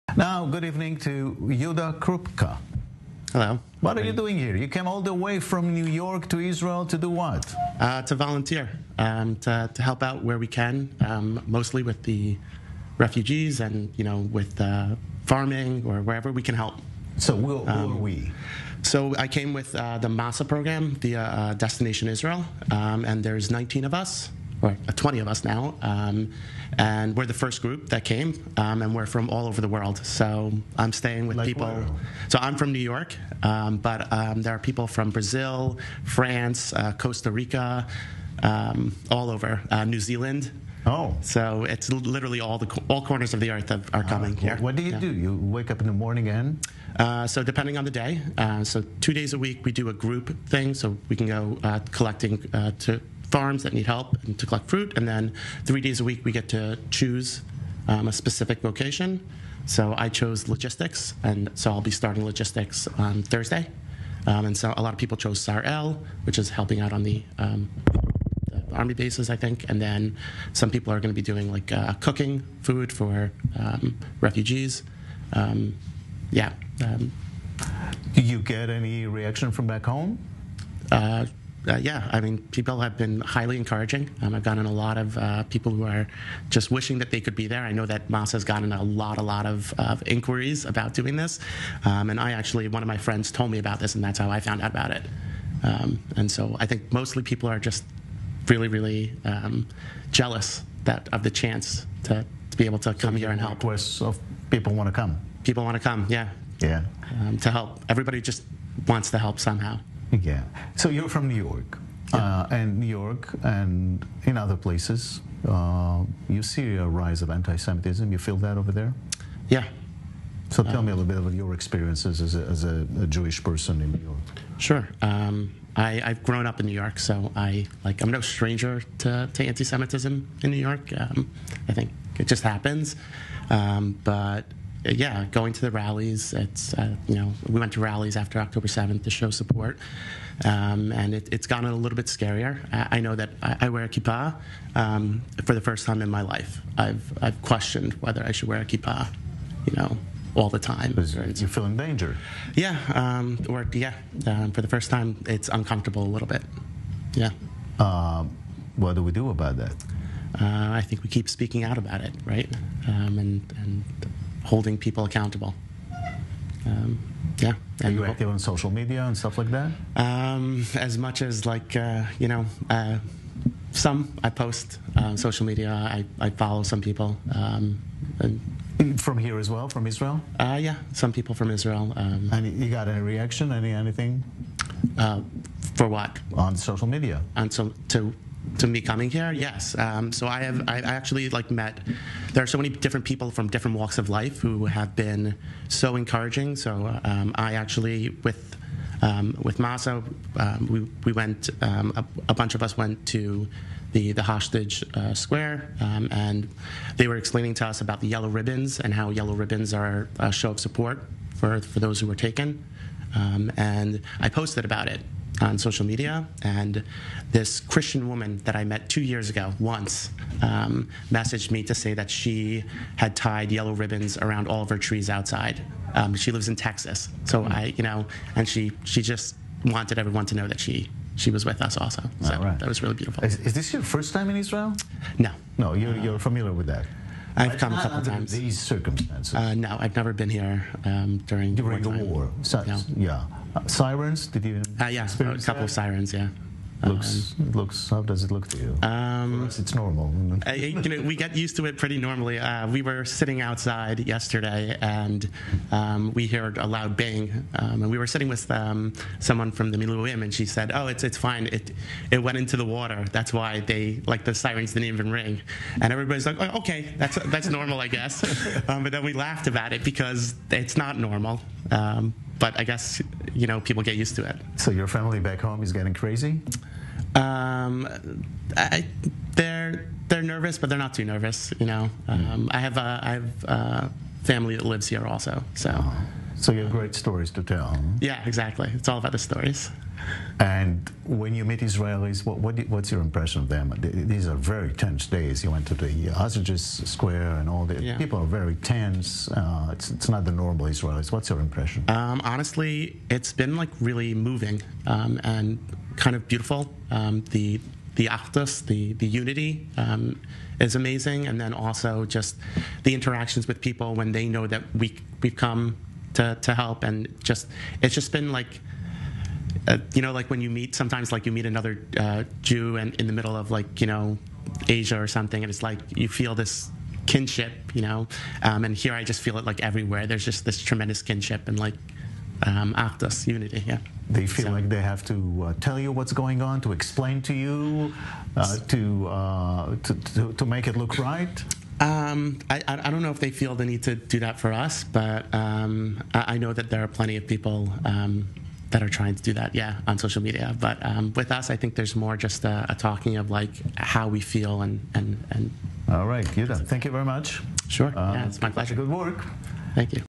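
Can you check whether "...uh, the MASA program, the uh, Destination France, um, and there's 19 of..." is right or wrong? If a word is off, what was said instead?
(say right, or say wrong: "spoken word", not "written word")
wrong: "Israel", not "France".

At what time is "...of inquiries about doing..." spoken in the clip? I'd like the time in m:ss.
1:29.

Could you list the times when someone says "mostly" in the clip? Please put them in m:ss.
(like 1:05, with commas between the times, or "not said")
0:11, 1:36.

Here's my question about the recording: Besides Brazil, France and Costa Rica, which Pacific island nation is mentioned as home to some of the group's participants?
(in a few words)
New Zealand.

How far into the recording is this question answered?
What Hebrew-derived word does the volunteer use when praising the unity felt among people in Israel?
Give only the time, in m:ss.
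5:08.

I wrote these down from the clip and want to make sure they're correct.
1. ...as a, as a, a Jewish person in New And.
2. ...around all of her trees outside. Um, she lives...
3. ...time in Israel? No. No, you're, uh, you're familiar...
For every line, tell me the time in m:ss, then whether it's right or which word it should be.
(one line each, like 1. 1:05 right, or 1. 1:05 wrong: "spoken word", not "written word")
1. 2:02 wrong: "York", not "And"
2. 3:44 right
3. 3:54 right.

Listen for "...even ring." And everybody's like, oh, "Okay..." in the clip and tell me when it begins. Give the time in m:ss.
4:24.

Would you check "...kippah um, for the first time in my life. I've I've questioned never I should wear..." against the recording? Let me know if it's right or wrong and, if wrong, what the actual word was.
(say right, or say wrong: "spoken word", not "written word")
wrong: "whether", not "never".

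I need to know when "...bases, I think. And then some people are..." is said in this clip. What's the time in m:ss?
1:08.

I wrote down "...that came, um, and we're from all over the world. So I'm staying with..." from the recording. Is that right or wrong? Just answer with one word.
right.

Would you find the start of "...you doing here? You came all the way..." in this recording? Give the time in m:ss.
0:04.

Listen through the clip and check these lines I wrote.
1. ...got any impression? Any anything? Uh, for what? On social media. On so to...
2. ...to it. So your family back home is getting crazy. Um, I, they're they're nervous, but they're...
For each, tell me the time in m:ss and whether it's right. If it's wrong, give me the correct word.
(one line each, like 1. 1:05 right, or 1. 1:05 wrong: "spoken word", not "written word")
1. 3:02 wrong: "reaction", not "impression"
2. 4:34 right.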